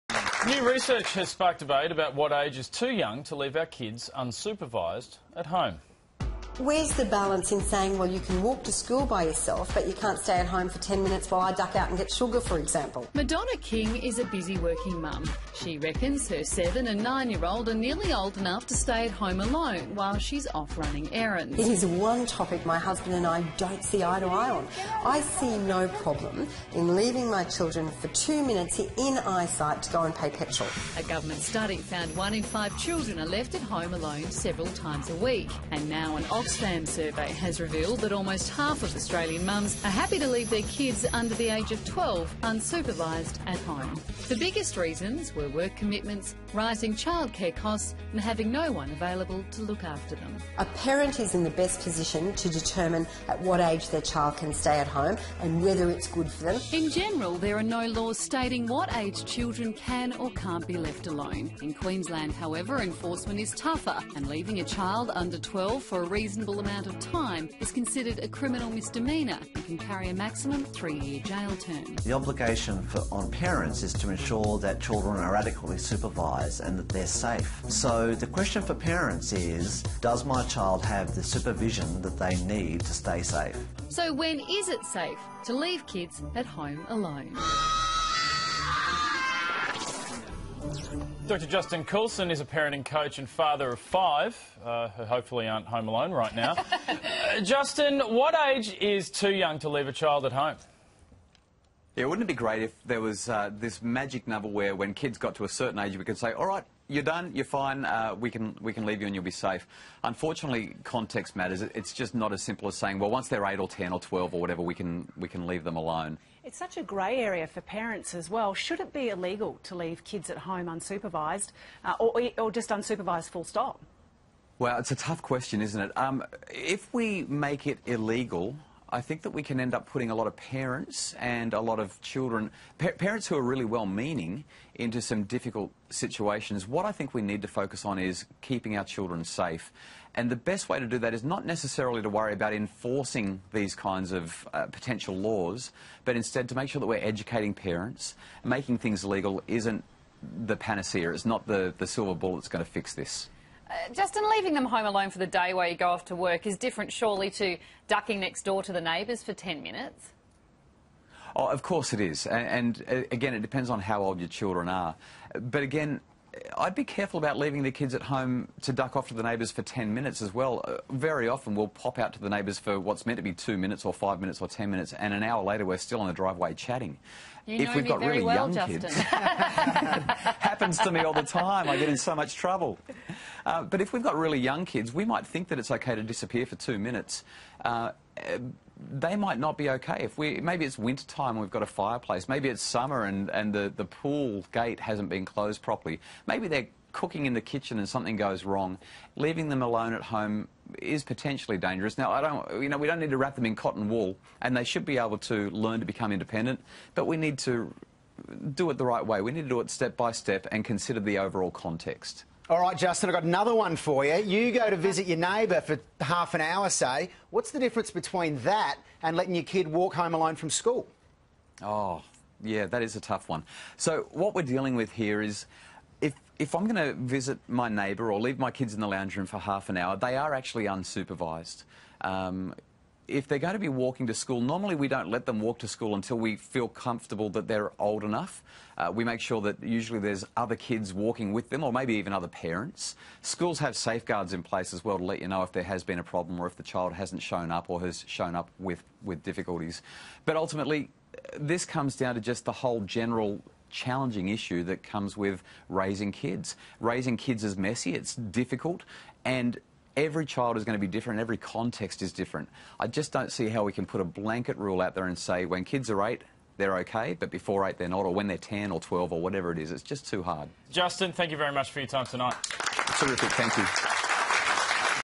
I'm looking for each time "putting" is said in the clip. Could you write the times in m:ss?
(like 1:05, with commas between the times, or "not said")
2:09.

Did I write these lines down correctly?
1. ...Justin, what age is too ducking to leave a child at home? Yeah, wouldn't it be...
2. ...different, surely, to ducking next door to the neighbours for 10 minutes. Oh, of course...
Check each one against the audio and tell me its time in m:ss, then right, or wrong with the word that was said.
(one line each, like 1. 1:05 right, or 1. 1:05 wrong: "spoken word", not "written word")
1. 1:37 wrong: "young", not "ducking"
2. 2:36 right.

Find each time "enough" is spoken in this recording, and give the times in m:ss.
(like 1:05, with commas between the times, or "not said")
0:18, 3:58.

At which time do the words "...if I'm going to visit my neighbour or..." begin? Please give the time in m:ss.
3:46.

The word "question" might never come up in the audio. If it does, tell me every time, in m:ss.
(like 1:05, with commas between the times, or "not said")
1:18, 2:05.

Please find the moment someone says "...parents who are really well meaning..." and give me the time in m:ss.
2:12.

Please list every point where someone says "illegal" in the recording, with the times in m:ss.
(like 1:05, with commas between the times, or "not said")
1:59, 2:07.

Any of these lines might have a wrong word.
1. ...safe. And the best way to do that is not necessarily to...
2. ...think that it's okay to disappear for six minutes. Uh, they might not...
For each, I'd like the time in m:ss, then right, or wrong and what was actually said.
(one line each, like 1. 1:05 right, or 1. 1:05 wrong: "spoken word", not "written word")
1. 2:19 right
2. 3:05 wrong: "two", not "six".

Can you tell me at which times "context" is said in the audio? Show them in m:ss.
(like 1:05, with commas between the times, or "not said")
1:50, 3:31, 4:21.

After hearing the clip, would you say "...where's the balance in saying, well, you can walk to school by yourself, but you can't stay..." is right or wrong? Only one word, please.
right.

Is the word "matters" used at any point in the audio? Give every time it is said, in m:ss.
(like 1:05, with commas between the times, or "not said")
1:51.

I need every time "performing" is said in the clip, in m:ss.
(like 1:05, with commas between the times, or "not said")
not said.